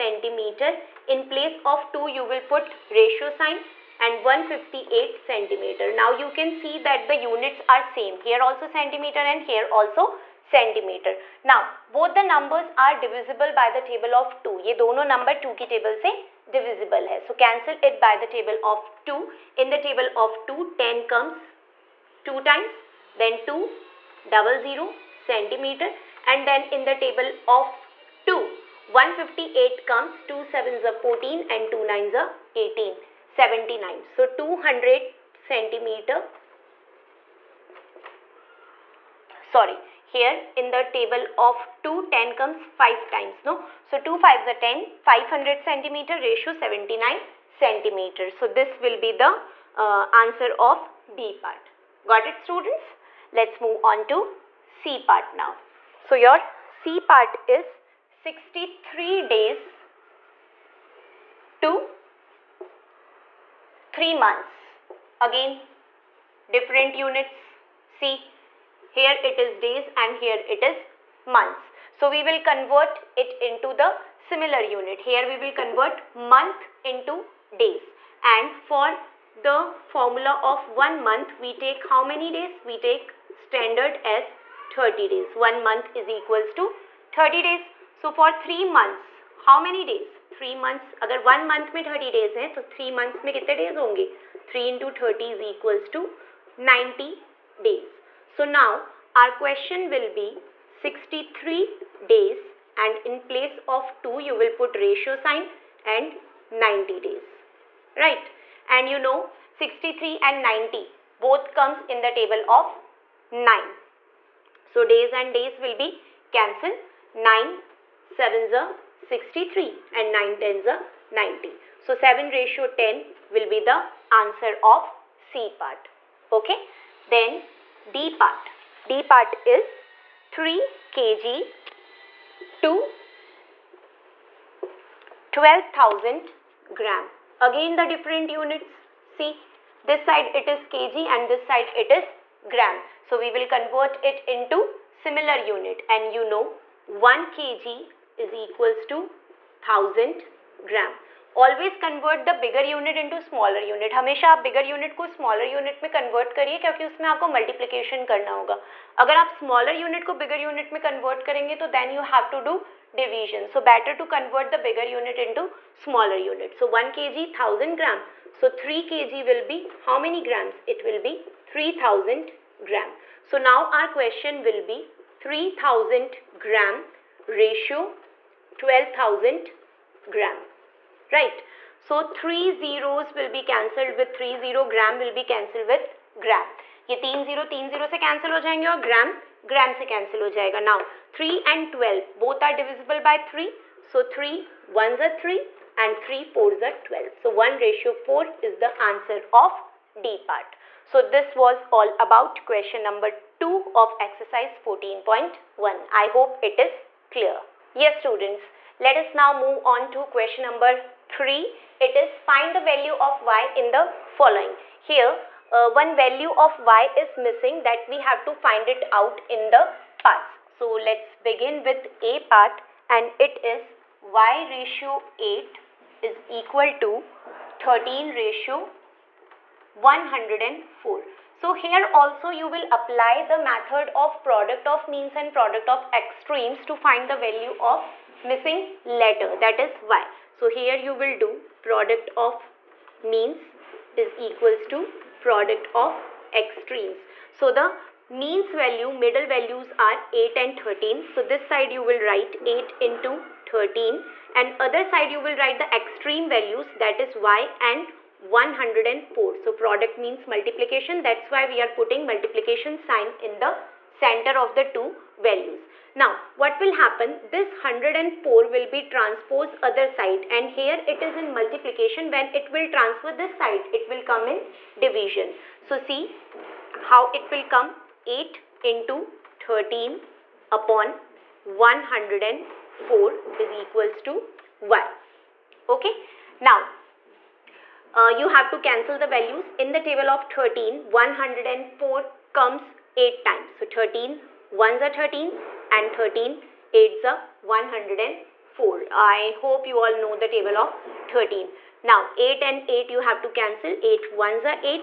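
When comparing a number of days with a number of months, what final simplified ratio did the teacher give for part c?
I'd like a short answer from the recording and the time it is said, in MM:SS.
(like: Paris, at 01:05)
7:10, at 02:01.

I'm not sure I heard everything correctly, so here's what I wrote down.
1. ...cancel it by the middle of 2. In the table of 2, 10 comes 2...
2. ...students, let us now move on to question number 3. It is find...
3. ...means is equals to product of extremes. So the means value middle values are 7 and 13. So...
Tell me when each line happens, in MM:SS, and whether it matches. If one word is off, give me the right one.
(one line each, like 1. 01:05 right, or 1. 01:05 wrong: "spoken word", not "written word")
1. 00:17 wrong: "table", not "middle"
2. 03:27 right
3. 04:03 wrong: "8", not "7".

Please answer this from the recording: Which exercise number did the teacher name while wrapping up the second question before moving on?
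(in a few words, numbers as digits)
14.1.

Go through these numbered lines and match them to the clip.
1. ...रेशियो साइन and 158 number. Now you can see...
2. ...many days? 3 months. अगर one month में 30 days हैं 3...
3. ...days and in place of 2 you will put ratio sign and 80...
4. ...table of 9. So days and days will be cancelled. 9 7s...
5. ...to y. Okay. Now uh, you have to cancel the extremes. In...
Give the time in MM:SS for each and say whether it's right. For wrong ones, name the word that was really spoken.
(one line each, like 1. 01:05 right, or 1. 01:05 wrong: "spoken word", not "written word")
1. 00:02 wrong: "centimeter", not "number"
2. 01:29 right
3. 01:42 wrong: "90", not "80"
4. 01:52 right
5. 04:44 wrong: "values", not "extremes".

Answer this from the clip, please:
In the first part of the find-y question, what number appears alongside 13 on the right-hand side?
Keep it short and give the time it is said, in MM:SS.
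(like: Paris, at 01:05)
104, at 03:47.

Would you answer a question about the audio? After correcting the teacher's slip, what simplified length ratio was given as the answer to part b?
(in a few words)
500 centimeter : 79 centimeter.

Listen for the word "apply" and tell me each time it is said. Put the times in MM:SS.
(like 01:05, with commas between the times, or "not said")
03:52.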